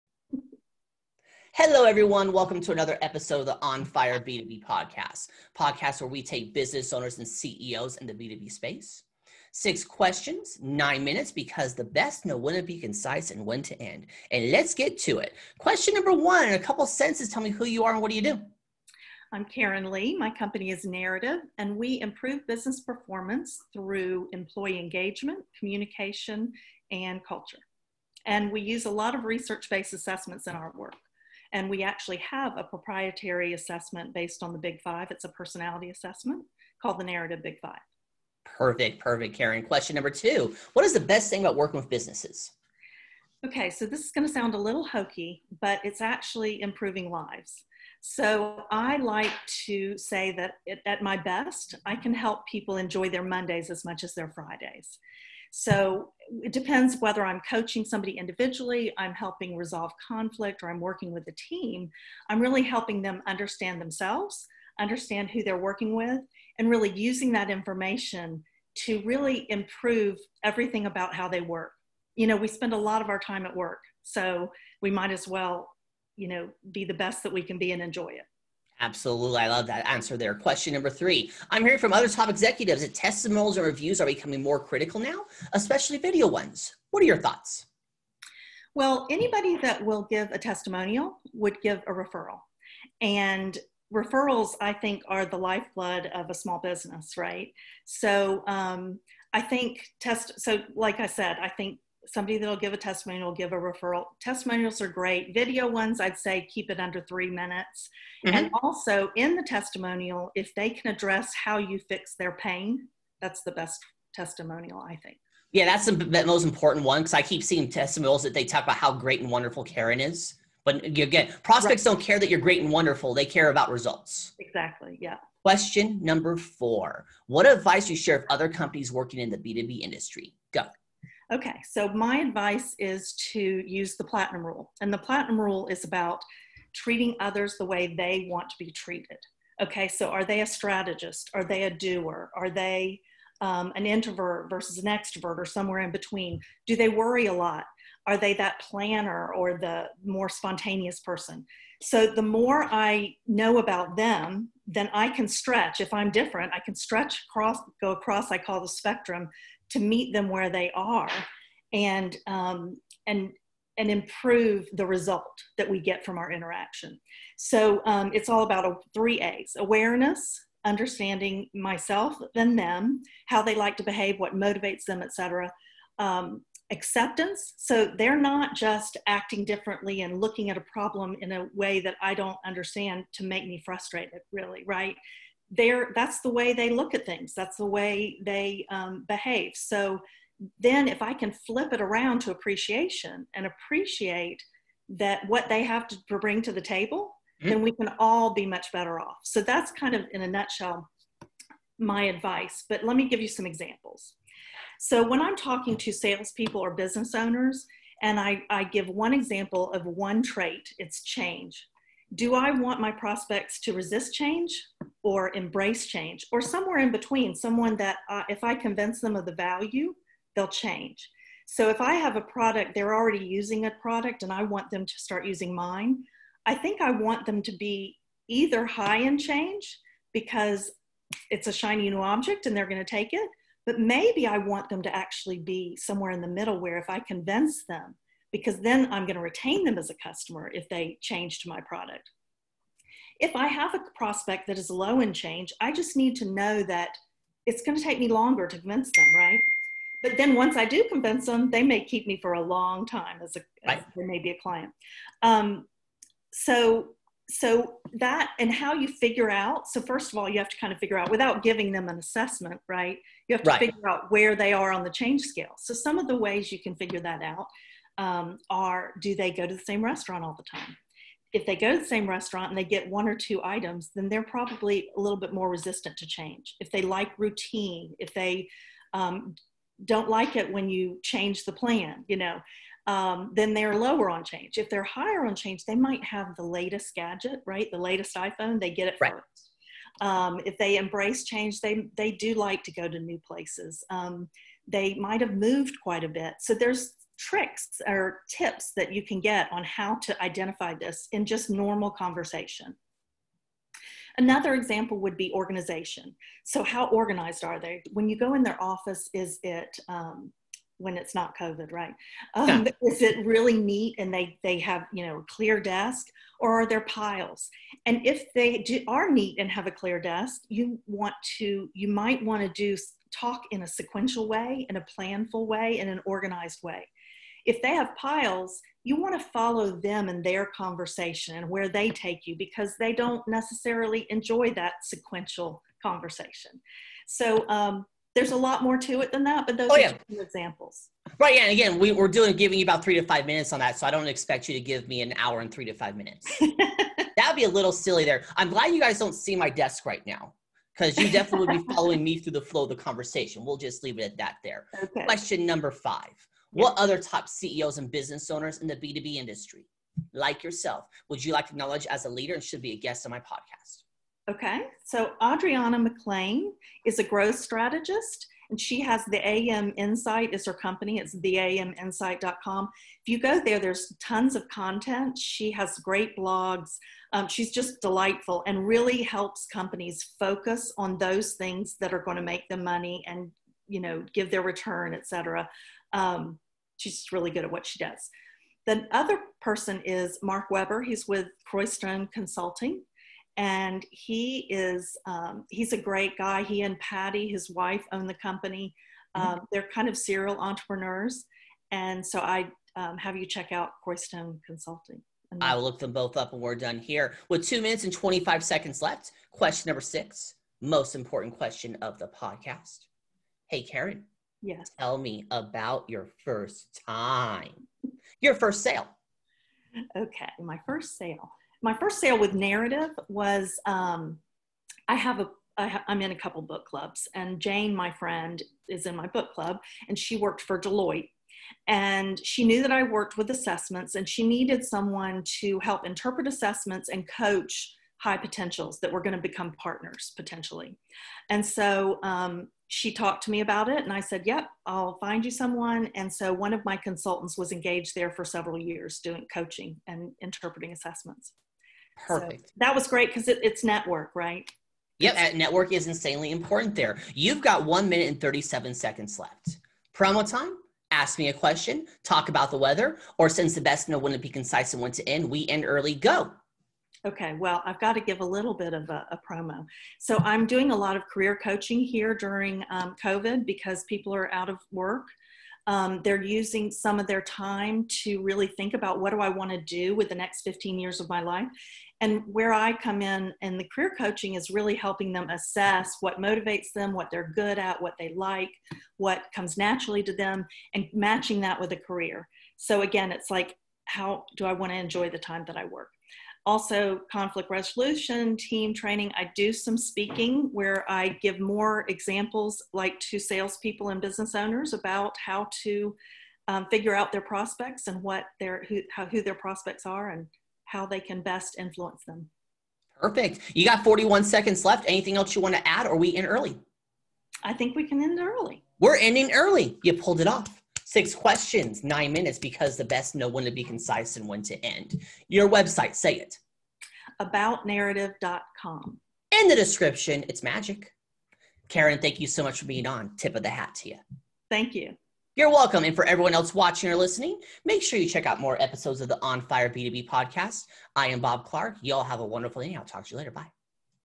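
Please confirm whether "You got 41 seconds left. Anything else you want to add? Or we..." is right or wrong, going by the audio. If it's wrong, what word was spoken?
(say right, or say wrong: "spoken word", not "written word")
right.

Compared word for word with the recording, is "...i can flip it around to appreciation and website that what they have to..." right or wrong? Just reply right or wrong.
wrong.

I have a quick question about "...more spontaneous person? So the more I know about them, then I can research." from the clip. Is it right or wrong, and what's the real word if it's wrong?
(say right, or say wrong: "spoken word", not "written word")
wrong: "stretch", not "research".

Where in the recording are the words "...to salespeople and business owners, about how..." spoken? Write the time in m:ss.
8:23.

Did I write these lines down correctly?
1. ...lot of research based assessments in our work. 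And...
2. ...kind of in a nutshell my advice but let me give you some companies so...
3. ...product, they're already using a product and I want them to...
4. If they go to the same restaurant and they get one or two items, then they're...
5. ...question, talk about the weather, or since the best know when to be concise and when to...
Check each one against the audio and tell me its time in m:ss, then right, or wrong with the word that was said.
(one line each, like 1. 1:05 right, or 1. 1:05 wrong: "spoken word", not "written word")
1. 0:28 right
2. 3:19 wrong: "examples", not "companies"
3. 3:42 right
4. 4:31 right
5. 7:41 right.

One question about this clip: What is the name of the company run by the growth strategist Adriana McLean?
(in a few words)
AM Insight.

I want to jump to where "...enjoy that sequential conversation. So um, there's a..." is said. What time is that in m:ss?
5:34.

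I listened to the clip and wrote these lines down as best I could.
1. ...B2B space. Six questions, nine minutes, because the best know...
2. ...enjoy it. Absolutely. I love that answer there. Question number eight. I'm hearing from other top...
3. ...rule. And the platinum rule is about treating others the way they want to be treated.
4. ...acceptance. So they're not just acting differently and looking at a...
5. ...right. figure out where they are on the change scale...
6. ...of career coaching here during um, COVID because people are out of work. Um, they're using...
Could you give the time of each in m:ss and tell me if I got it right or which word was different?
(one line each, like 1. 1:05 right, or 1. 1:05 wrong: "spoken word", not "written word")
1. 0:08 right
2. 1:17 wrong: "three", not "eight"
3. 2:14 right
4. 2:56 right
5. 4:23 right
6. 7:50 right.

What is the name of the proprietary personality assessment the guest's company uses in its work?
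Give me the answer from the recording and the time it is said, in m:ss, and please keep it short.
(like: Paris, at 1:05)
Narrative Big Five, at 0:37.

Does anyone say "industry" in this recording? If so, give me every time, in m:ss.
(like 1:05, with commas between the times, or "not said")
2:09, 5:59.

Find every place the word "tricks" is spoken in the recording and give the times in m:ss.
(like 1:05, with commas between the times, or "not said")
4:57.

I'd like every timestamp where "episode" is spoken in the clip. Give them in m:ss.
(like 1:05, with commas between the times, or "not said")
0:03, 8:58.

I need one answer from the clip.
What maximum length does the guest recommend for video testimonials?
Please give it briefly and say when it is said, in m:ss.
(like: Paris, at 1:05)
3 minutes, at 1:46.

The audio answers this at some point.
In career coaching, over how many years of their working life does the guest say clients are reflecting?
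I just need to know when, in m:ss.
8:00.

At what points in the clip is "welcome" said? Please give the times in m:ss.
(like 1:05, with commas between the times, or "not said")
0:02, 8:55.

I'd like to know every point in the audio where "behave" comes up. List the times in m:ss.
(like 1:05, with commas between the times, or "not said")
2:53, 3:09.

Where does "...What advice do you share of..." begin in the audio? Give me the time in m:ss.
2:07.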